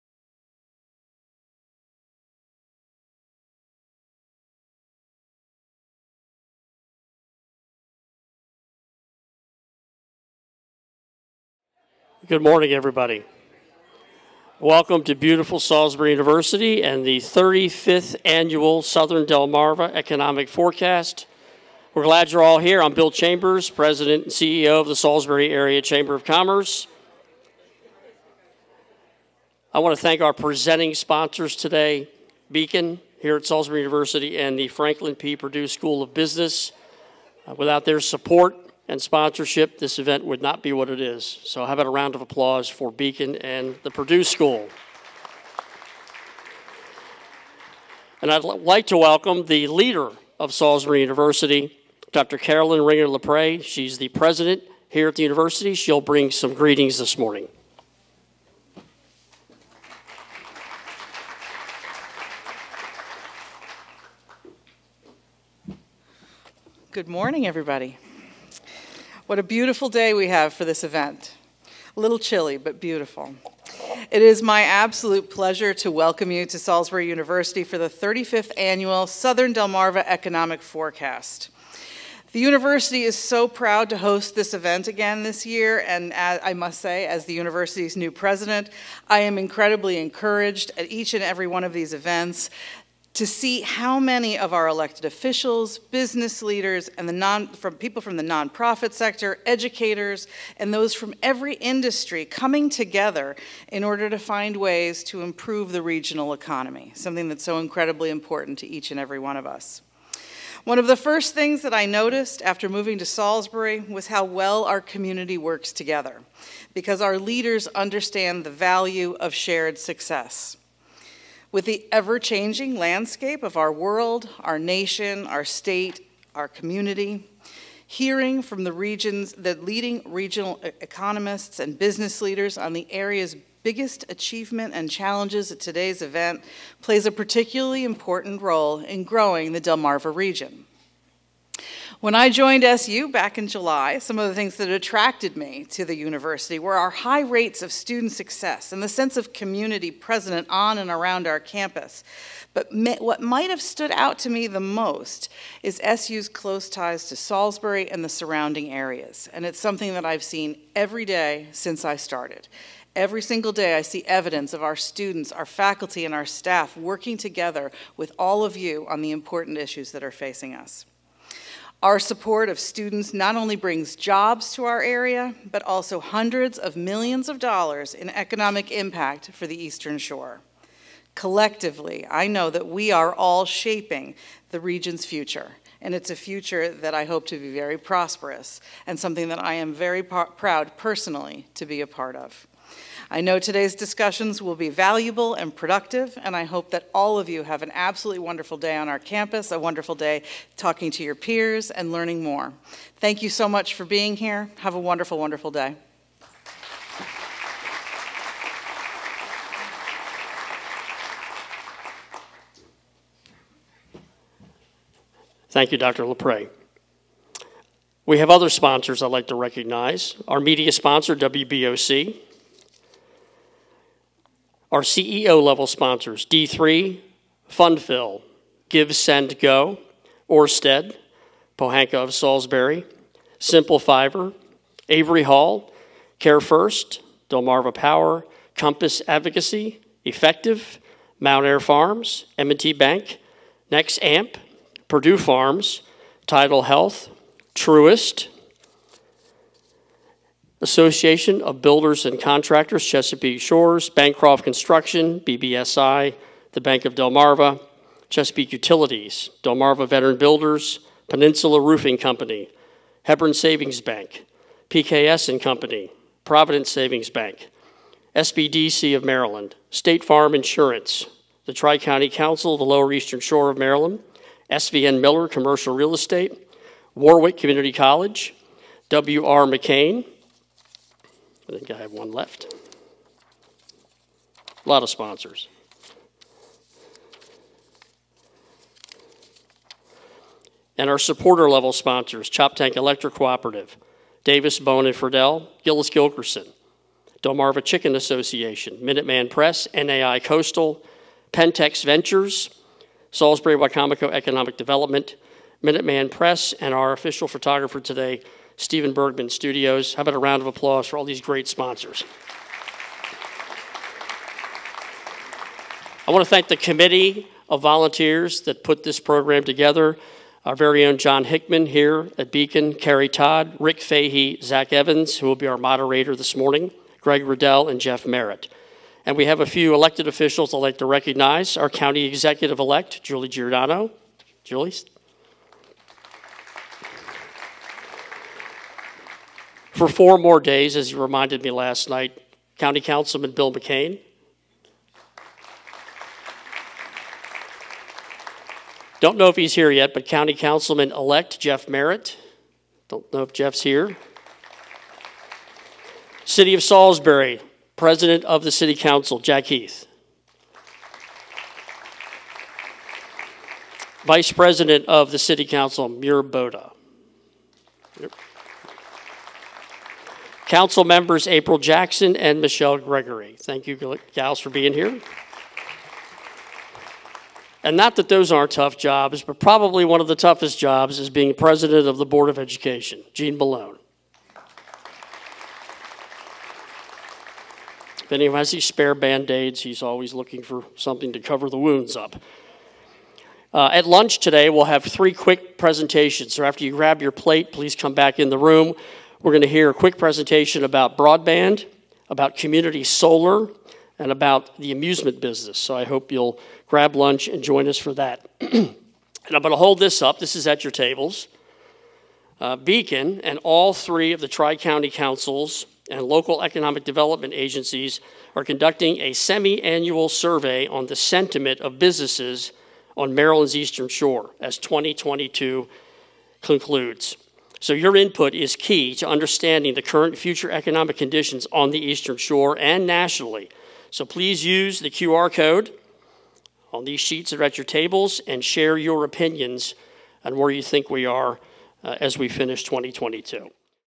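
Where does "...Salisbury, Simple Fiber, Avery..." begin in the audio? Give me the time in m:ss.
3:52.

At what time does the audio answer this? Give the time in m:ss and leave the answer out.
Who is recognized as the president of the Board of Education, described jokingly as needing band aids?
6:23.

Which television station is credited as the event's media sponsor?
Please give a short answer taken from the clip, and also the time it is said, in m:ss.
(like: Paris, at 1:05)
WBOC, at 3:41.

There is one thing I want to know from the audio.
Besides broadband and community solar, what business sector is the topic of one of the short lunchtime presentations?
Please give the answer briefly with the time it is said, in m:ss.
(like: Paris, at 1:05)
amusement business, at 6:44.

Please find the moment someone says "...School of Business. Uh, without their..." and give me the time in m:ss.
0:35.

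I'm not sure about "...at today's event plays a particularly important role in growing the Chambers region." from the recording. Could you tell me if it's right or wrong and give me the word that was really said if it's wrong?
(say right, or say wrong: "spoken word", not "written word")
wrong: "Delmarva", not "Chambers".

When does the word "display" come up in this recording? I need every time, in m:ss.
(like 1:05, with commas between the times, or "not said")
not said.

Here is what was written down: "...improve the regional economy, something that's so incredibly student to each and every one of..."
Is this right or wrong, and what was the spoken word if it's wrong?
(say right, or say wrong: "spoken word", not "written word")
wrong: "important", not "student".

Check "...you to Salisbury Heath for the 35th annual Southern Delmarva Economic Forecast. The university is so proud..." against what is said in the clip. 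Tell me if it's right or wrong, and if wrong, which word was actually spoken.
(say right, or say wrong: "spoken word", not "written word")
wrong: "University", not "Heath".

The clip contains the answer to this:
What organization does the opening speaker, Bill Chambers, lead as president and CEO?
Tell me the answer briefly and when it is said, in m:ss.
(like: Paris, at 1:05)
Salisbury Area Chamber of Commerce, at 0:24.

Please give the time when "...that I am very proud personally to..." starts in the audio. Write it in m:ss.
3:09.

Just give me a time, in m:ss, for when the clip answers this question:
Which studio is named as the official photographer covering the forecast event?
5:08.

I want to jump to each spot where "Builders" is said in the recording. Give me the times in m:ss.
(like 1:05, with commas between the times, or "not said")
4:11, 4:20.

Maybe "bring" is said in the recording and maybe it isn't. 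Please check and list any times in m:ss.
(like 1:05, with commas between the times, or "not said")
0:56, 2:53.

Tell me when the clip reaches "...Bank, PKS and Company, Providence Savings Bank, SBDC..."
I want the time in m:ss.
4:23.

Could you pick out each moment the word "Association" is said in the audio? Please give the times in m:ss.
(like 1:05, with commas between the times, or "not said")
4:10, 4:57.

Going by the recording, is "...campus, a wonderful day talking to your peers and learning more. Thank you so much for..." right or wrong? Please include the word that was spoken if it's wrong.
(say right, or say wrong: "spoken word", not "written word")
right.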